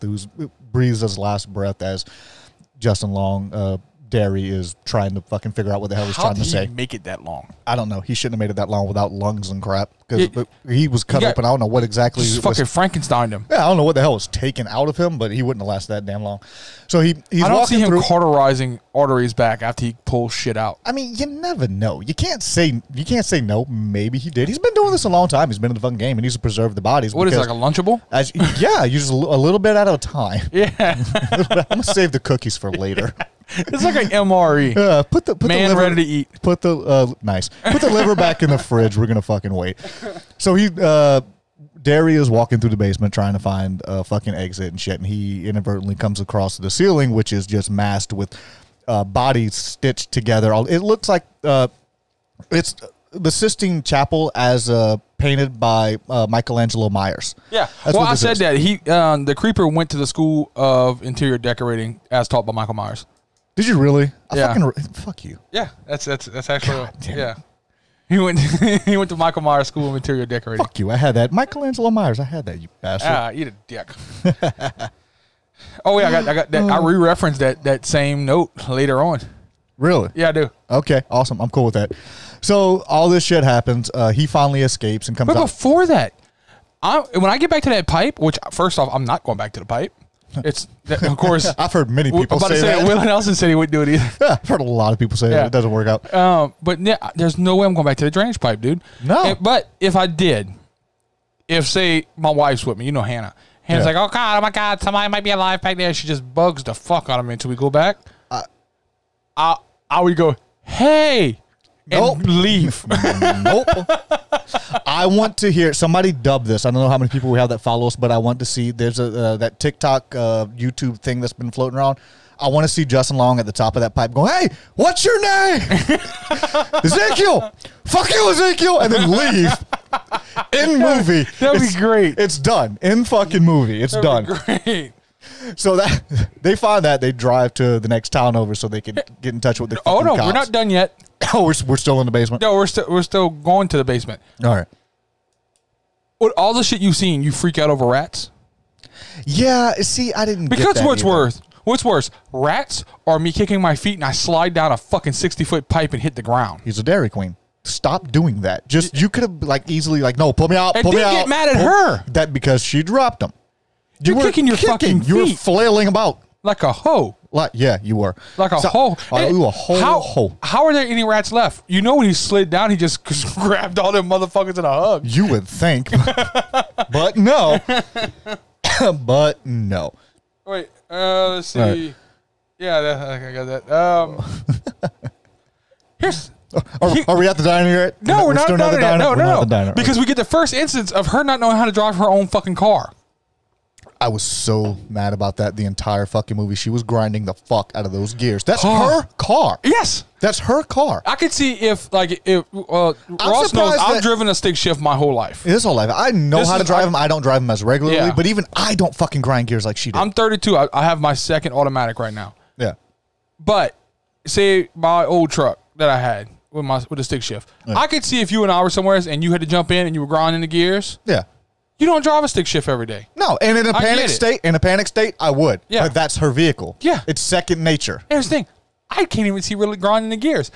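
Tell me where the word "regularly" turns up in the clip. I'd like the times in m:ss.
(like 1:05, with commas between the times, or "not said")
3:27.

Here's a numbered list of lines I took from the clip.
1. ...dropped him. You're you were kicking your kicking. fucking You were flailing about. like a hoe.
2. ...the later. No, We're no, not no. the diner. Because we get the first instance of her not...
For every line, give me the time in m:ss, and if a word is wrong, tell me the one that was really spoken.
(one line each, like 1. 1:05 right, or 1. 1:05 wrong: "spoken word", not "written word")
1. 2:42 right
2. 3:08 wrong: "diner", not "later".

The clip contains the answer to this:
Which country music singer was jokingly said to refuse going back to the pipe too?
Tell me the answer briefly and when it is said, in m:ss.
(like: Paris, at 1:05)
Willie Nelson, at 1:32.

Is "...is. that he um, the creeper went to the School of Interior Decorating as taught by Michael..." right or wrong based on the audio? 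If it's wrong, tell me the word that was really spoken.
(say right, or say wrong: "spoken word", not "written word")
right.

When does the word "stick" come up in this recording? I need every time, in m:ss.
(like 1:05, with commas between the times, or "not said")
3:24, 3:37, 3:42.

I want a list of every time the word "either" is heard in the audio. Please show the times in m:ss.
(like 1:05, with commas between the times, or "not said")
1:33, 2:31.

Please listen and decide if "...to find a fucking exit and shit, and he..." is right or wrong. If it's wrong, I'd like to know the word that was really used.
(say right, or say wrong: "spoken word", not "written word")
right.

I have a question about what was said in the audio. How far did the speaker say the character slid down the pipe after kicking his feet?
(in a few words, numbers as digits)
60 feet.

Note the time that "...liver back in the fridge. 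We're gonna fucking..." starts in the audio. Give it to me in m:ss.
0:37.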